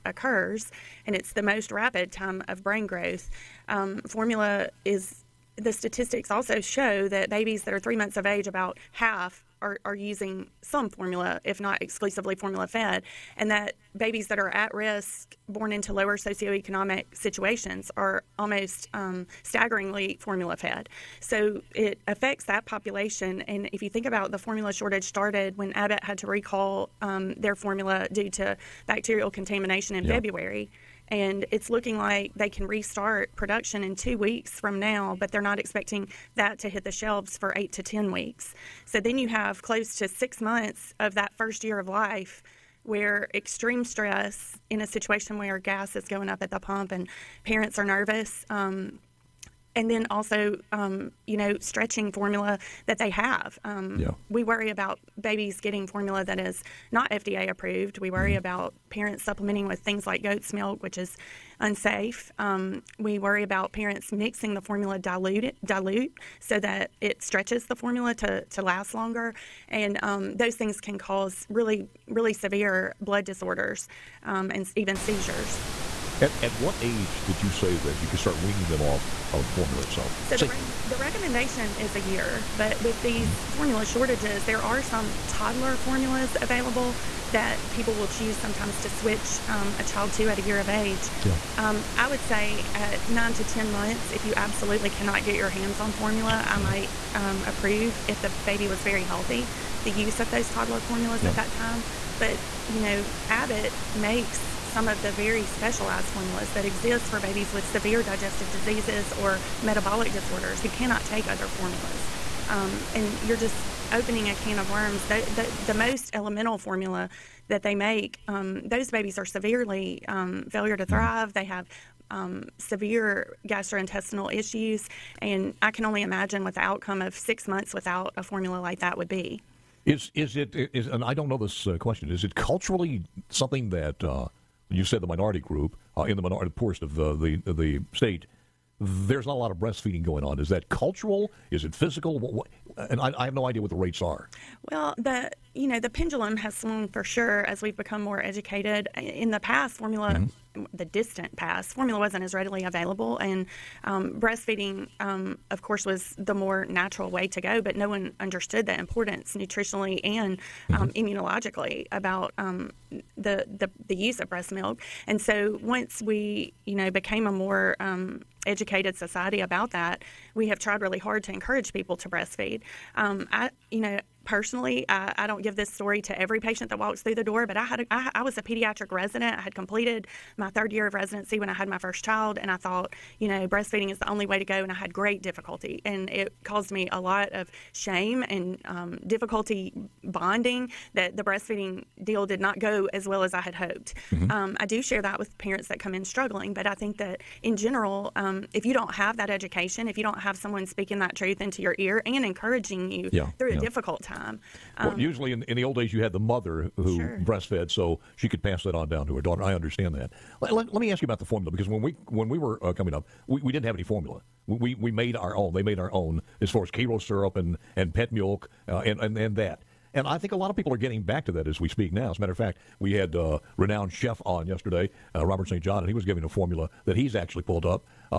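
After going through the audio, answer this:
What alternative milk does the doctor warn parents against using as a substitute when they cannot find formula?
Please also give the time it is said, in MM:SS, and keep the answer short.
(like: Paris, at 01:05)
Goat's milk, at 01:00.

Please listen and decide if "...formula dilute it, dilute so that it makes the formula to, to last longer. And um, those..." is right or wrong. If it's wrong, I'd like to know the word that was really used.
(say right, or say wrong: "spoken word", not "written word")
wrong: "stretches", not "makes".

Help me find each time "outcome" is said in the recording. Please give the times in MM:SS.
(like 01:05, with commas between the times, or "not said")
02:06.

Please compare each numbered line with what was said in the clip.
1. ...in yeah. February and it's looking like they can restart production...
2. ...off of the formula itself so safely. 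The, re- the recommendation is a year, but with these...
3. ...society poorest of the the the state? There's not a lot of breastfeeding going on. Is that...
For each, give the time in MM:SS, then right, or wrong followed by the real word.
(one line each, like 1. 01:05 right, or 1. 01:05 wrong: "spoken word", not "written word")
1. 00:29 right
2. 01:18 right
3. 02:16 wrong: "minority", not "society".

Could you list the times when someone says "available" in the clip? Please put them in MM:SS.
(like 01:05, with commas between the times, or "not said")
01:26, 02:32.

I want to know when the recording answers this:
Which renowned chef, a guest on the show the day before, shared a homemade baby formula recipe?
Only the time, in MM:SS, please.
03:45.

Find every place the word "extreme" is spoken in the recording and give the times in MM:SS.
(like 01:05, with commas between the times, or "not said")
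00:43.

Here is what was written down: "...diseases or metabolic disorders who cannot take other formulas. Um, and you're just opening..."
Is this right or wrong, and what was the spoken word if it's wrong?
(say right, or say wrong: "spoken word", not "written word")
right.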